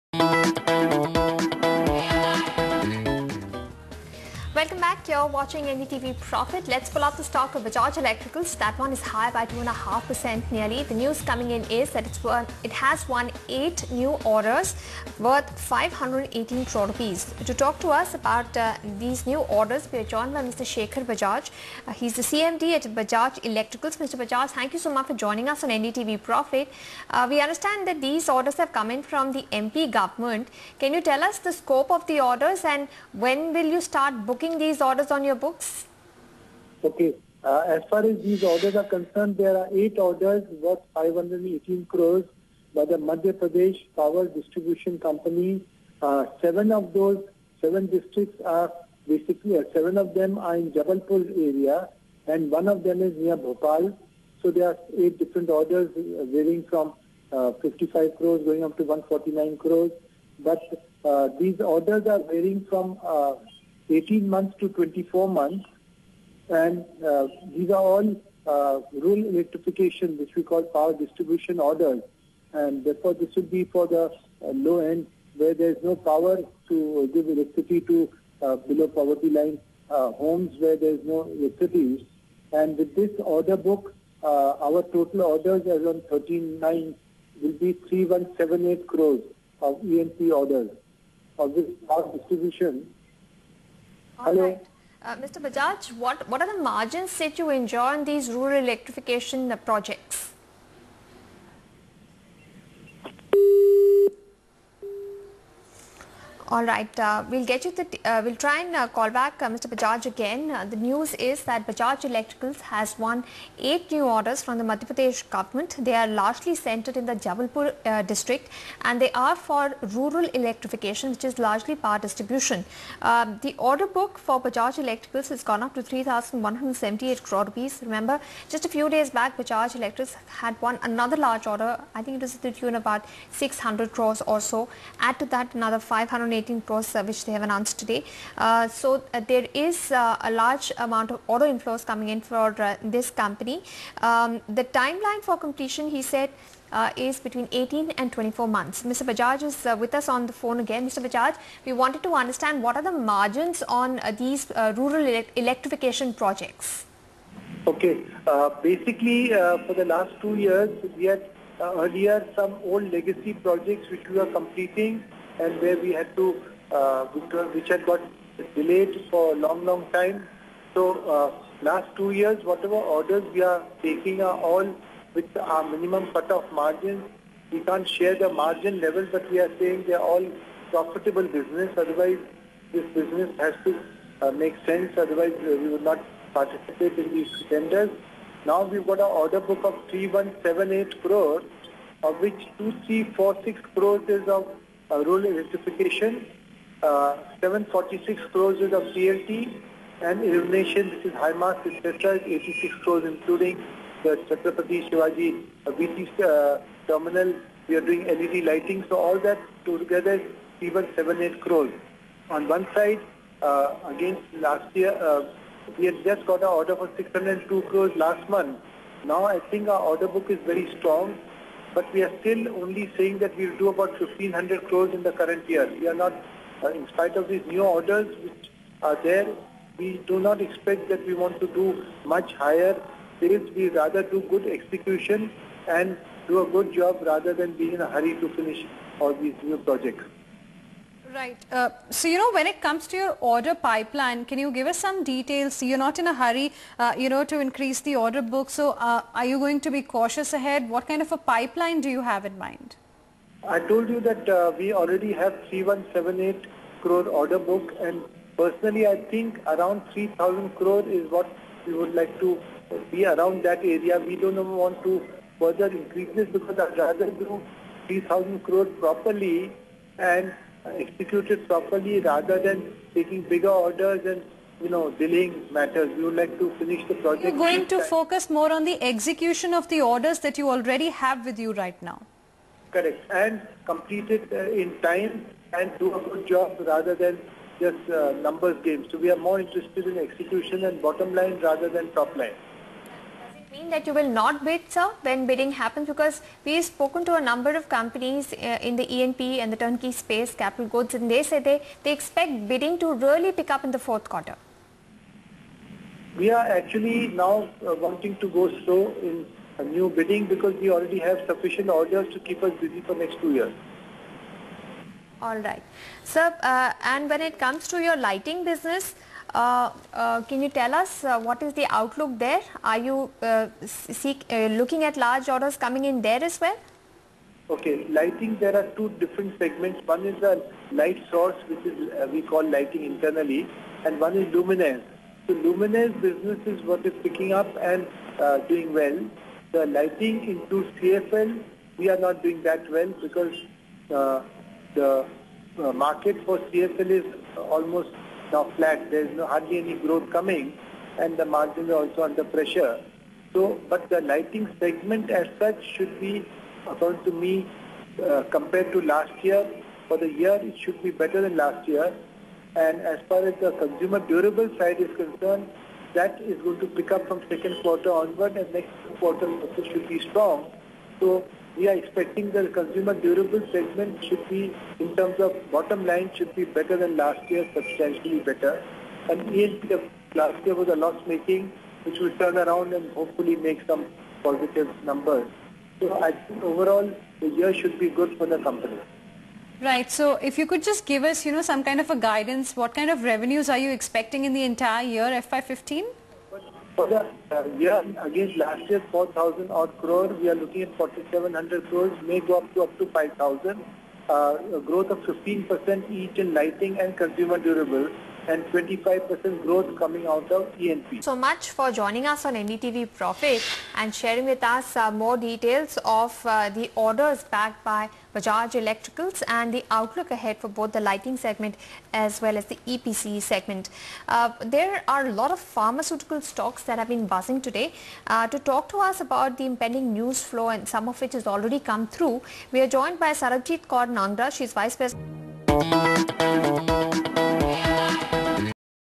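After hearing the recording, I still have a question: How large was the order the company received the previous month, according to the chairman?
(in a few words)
602 crores.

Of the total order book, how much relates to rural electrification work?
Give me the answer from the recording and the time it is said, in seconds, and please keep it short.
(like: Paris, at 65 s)
2346 crores, at 192 s.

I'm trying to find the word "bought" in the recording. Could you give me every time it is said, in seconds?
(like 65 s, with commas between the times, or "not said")
not said.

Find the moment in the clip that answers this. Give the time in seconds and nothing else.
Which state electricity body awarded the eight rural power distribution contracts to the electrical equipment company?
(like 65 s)
42 s.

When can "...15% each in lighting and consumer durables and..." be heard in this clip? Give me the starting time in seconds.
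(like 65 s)
404 s.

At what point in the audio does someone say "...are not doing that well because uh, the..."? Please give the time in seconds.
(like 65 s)
341 s.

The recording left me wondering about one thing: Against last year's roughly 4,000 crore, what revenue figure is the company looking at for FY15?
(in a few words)
4,700 crores.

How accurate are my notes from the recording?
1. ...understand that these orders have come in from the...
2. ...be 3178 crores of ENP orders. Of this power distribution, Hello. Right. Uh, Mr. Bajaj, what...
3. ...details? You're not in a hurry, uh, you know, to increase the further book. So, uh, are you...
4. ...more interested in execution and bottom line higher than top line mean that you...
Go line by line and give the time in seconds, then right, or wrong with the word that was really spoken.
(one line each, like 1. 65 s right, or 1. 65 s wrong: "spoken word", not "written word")
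1. 27 s right
2. 87 s right
3. 245 s wrong: "order", not "further"
4. 289 s wrong: "rather", not "higher".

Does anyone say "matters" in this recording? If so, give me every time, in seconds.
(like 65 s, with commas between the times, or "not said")
275 s.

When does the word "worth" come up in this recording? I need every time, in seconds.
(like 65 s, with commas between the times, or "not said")
15 s, 40 s.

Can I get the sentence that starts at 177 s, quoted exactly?
We can't share the margin level, but we are saying they are all profitable business.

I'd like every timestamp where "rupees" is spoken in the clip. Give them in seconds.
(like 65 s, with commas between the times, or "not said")
16 s, 127 s.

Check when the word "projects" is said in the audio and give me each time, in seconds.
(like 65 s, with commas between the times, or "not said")
99 s, 156 s, 163 s, 239 s, 276 s.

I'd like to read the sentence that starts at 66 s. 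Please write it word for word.
And uh, these are all uh, rural electrification, which we call power distribution orders.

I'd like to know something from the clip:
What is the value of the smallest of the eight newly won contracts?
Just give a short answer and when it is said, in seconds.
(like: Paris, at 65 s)
55 crores, at 57 s.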